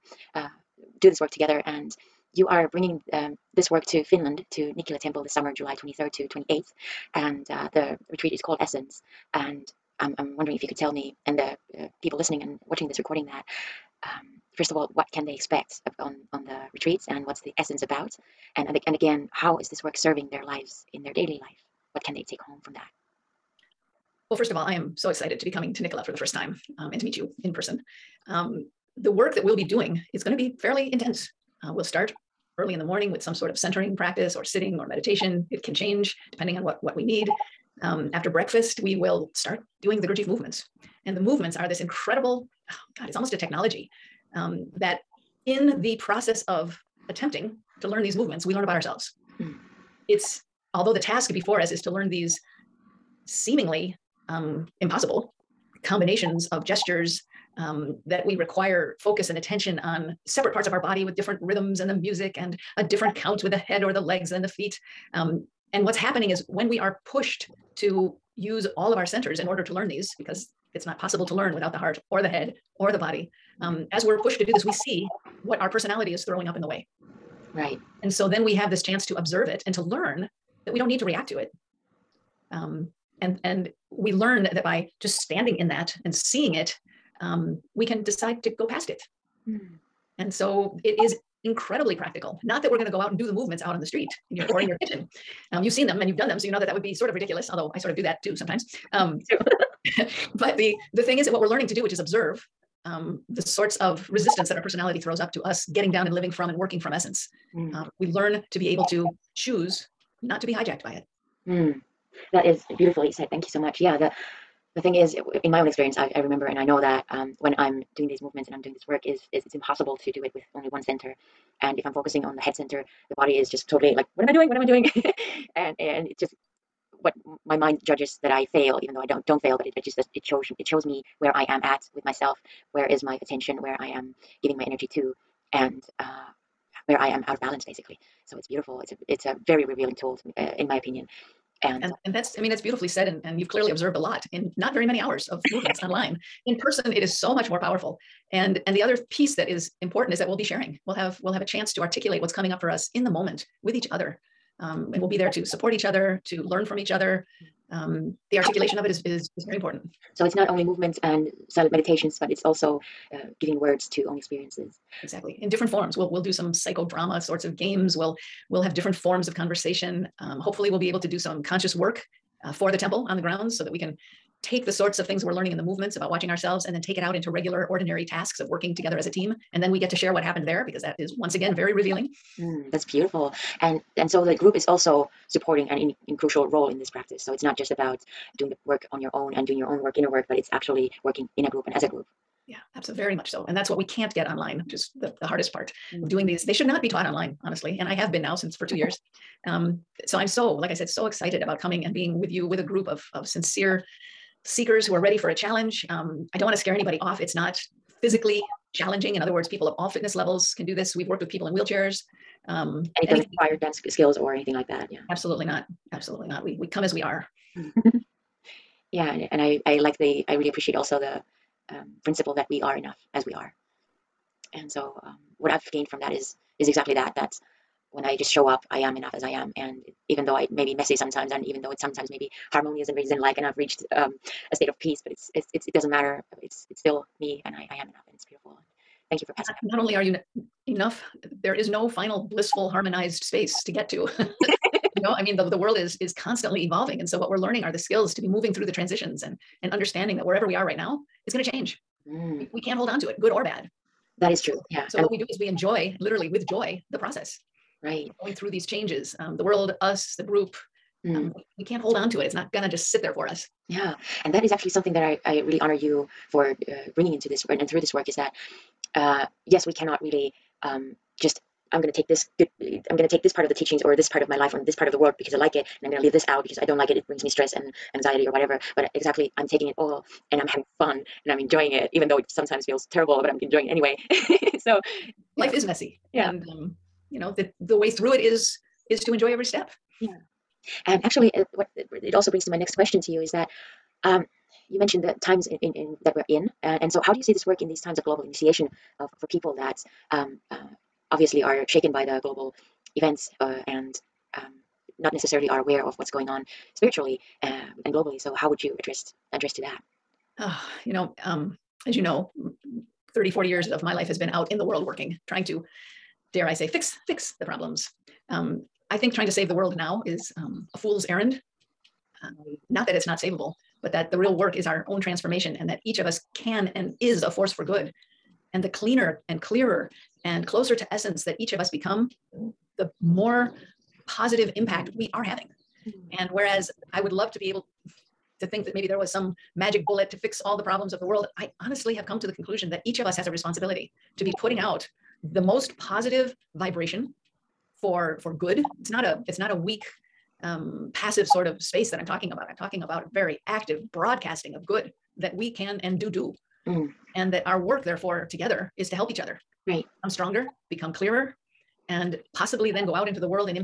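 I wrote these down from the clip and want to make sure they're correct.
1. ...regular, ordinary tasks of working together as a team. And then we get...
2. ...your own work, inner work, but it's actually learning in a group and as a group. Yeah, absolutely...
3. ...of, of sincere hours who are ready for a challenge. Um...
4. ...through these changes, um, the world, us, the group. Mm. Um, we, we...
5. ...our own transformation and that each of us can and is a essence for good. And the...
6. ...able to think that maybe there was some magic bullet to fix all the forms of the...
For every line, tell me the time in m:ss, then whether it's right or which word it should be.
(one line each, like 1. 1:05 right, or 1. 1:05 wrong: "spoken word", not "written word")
1. 2:57 right
2. 3:09 wrong: "working", not "learning"
3. 3:22 wrong: "seekers", not "hours"
4. 4:18 right
5. 5:24 wrong: "force", not "essence"
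6. 5:37 wrong: "problems", not "forms".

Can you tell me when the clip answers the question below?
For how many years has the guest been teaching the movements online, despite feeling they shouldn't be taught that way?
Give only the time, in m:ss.
3:18.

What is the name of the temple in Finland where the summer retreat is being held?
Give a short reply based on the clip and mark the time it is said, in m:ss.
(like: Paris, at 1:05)
Nikkila Temple, at 0:04.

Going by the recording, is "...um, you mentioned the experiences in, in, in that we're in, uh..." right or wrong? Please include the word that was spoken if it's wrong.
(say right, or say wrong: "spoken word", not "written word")
wrong: "times", not "experiences".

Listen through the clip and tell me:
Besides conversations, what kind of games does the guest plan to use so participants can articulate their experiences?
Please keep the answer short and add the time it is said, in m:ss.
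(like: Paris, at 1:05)
psychodrama, at 2:46.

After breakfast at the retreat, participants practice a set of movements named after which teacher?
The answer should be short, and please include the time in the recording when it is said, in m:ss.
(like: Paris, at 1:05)
Gurdjieff, at 0:40.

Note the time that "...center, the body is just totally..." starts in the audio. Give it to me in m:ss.
2:02.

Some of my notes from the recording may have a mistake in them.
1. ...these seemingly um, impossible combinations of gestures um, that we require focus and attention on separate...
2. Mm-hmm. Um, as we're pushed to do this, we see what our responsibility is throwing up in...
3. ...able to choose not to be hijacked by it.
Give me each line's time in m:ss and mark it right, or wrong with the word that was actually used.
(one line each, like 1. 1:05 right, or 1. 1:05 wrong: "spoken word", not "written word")
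1. 0:52 right
2. 1:13 wrong: "personality", not "responsibility"
3. 1:48 right.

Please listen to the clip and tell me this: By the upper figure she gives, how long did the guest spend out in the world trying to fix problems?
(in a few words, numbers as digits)
40 years.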